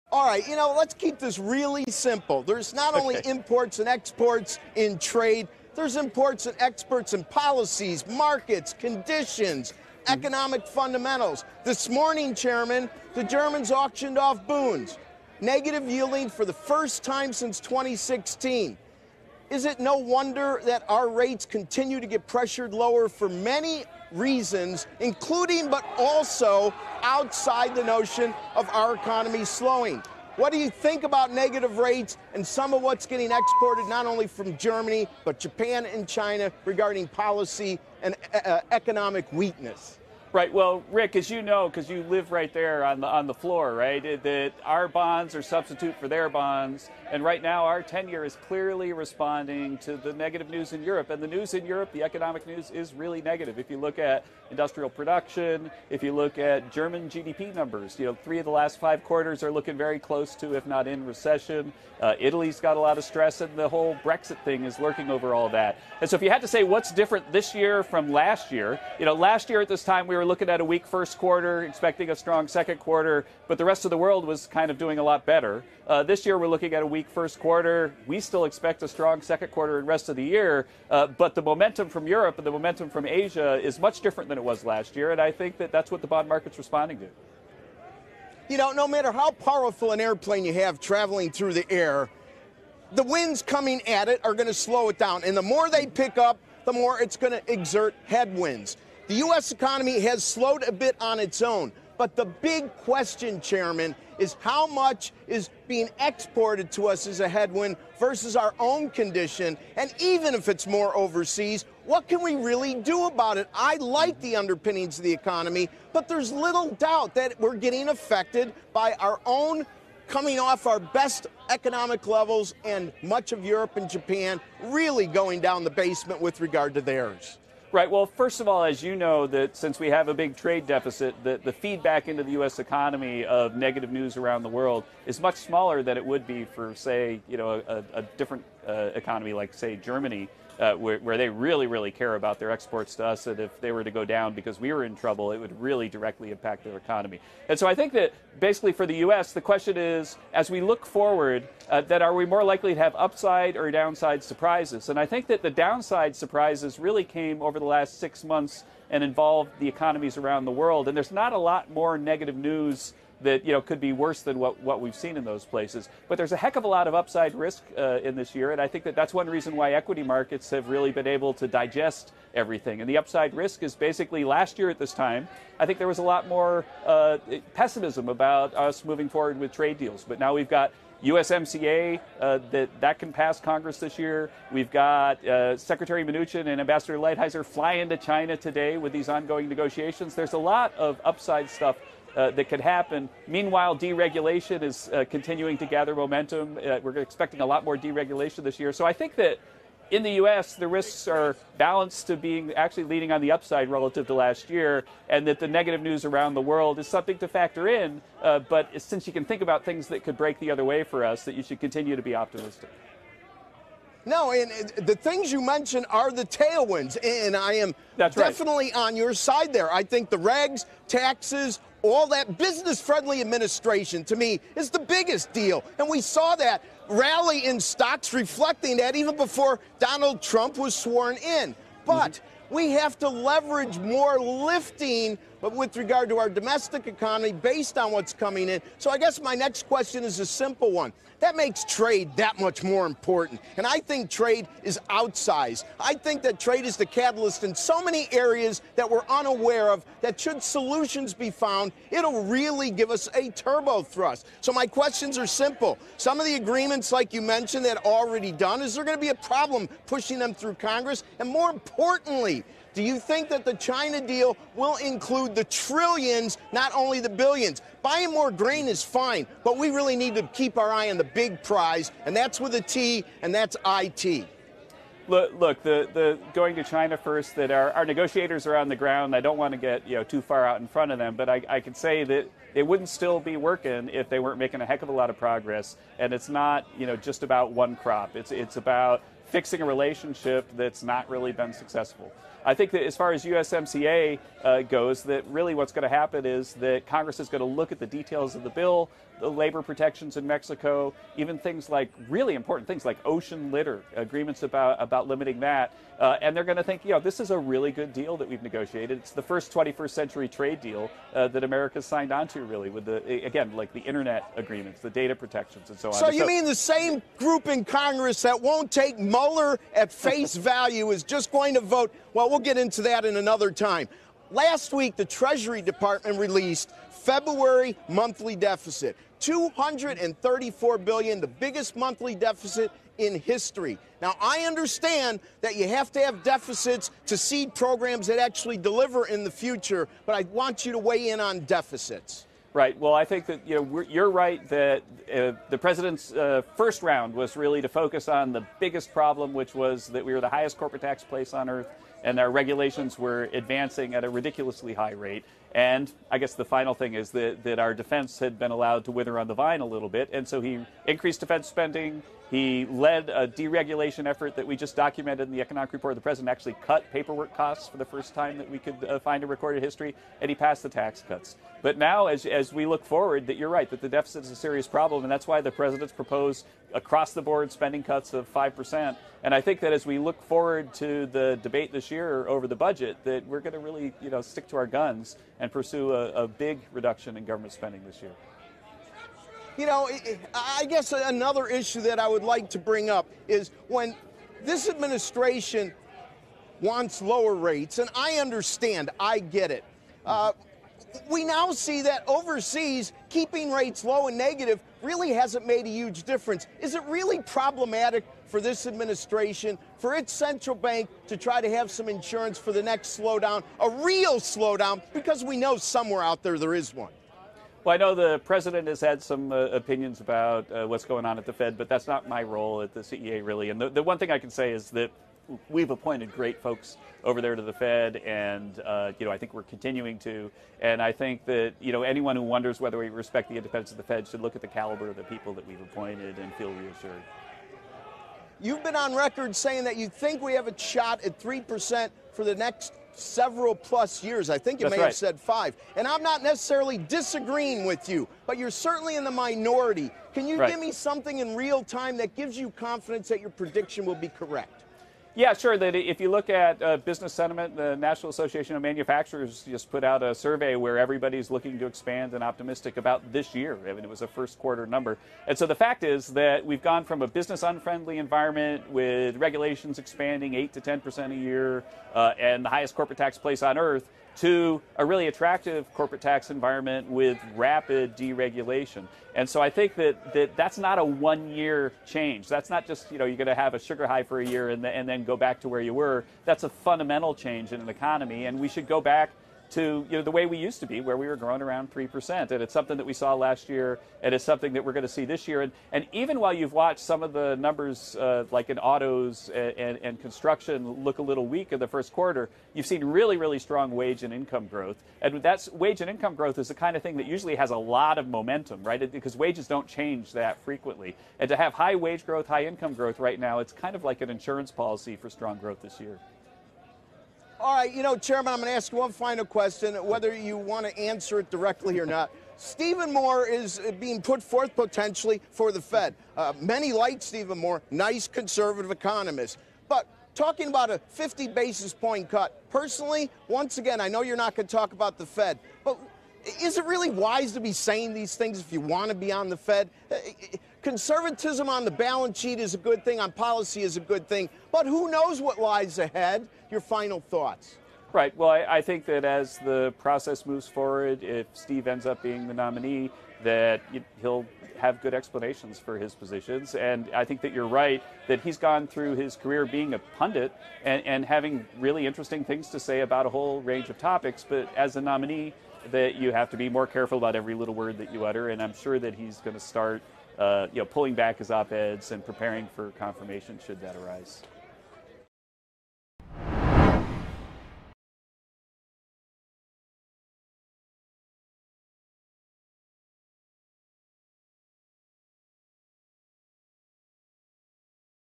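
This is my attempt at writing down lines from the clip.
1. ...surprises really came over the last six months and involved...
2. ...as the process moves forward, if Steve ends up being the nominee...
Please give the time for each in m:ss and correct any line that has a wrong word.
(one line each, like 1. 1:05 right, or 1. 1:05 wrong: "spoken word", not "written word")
1. 2:36 right
2. 9:09 right.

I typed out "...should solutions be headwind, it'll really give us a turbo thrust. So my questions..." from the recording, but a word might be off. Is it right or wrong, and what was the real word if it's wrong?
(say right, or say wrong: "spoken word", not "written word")
wrong: "found", not "headwind".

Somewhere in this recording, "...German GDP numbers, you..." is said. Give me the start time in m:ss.
0:56.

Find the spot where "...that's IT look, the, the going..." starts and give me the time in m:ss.
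4:33.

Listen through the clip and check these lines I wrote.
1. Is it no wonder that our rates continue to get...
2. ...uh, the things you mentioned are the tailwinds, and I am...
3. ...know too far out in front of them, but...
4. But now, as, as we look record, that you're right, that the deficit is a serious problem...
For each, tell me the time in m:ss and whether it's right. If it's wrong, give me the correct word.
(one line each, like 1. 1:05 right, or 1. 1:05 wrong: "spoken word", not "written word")
1. 0:19 right
2. 3:34 right
3. 4:39 right
4. 6:11 wrong: "forward", not "record".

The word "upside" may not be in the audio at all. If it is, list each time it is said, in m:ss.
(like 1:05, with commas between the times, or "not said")
2:32, 2:46, 2:52, 3:11, 3:23.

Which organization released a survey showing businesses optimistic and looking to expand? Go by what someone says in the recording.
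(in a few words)
National Association of Manufacturers.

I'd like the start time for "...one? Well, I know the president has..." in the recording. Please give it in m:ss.
6:56.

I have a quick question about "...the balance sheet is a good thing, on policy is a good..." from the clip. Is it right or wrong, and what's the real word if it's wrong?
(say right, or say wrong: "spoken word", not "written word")
right.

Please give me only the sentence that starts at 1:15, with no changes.
Uh, this year, we're looking at a weak first quarter.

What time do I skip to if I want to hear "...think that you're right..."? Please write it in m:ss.
9:17.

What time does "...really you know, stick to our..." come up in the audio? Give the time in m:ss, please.
6:23.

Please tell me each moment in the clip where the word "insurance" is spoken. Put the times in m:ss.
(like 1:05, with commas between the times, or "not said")
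6:51, 8:34.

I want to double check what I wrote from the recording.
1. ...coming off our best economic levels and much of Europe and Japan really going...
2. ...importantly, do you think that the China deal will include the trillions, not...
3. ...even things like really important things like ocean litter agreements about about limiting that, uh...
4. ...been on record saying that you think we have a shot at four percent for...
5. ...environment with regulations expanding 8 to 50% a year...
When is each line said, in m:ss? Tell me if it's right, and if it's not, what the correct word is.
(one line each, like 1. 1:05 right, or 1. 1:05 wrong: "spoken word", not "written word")
1. 2:00 right
2. 4:21 right
3. 5:01 right
4. 7:18 wrong: "three", not "four"
5. 7:47 wrong: "10", not "50".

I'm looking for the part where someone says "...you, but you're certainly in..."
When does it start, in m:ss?
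7:27.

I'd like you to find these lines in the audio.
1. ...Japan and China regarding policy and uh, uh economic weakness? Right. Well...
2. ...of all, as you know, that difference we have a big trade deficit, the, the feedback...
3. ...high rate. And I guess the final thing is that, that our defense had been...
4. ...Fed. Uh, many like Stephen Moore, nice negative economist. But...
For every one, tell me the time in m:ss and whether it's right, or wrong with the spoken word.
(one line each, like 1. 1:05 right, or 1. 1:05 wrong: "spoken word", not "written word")
1. 0:35 right
2. 2:08 wrong: "since", not "difference"
3. 5:54 right
4. 8:45 wrong: "conservative", not "negative".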